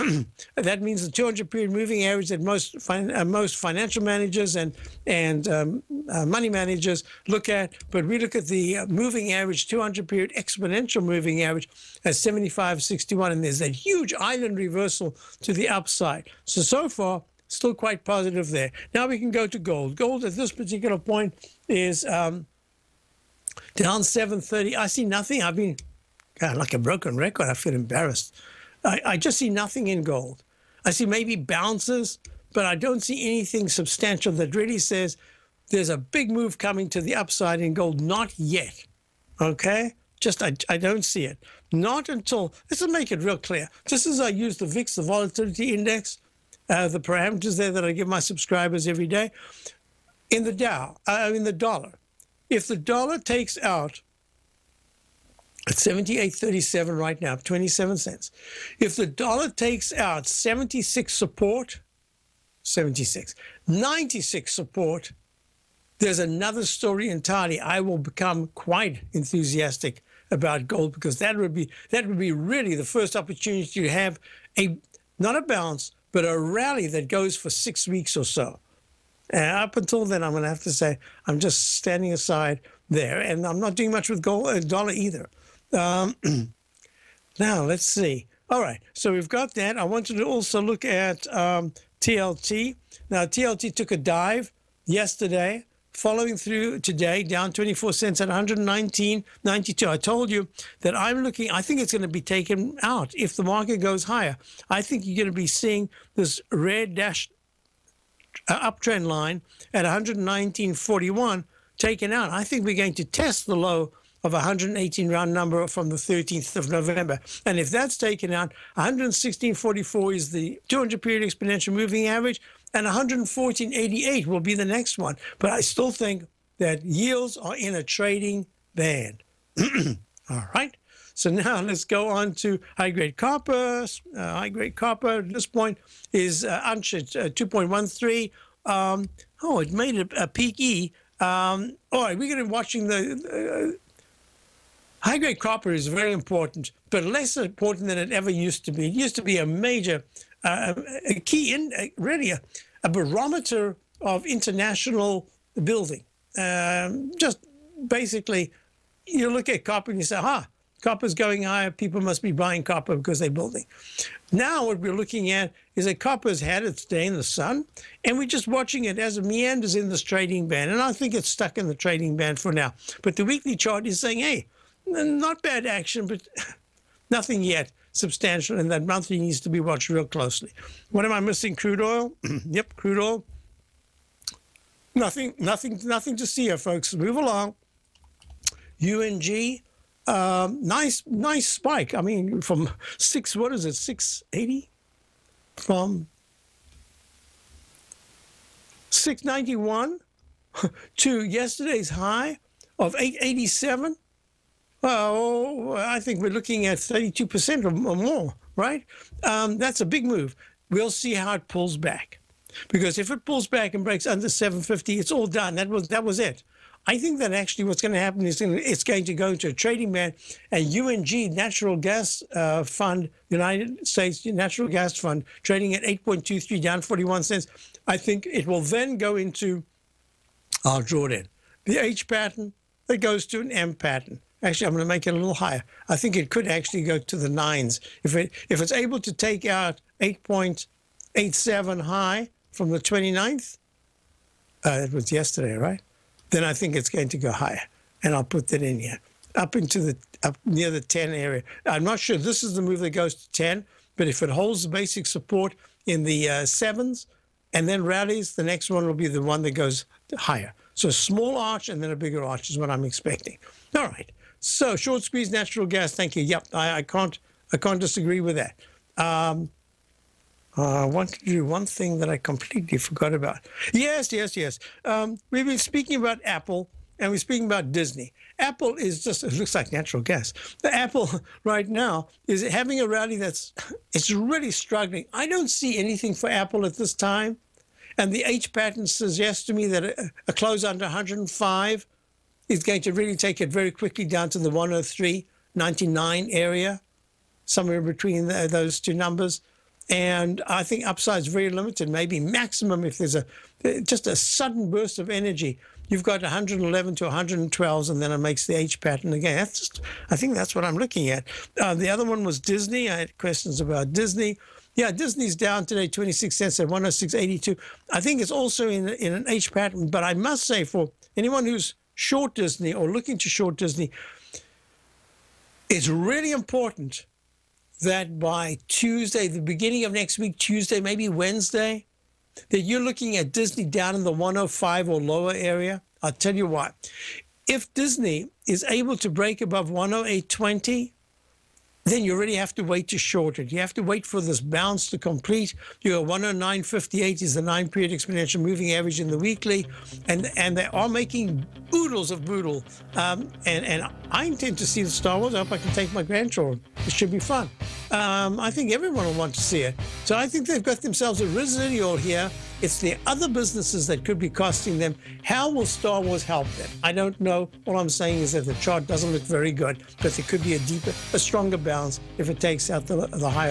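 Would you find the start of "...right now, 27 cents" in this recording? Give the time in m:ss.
0:56.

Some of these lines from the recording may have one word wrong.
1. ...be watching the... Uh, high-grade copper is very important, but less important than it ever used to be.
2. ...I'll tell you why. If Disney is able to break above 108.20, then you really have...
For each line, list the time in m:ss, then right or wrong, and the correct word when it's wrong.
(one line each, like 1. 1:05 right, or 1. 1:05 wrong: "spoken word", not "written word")
1. 2:22 right
2. 5:36 right.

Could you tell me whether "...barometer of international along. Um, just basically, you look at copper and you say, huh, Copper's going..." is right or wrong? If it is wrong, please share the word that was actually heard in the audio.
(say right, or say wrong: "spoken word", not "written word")
wrong: "building", not "along".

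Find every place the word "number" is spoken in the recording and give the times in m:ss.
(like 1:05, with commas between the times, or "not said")
1:55, 4:58.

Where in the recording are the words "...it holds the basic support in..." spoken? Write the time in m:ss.
4:14.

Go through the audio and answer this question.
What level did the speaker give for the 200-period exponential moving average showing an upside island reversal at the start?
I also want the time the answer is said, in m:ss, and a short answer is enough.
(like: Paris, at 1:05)
75.61, at 0:12.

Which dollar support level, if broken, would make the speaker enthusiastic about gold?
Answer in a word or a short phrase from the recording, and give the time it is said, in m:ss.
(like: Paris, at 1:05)
76.96, at 1:02.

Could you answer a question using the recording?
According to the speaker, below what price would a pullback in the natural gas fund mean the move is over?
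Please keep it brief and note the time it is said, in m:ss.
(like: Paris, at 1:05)
750, at 3:34.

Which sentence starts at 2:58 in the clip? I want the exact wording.
And that monthly needs to be watched real closely.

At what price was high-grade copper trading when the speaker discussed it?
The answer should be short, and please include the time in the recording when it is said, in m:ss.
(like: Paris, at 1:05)
2.13, at 2:16.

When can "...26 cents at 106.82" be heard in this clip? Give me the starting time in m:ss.
5:15.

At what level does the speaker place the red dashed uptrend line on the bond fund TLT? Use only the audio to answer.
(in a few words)
119.41.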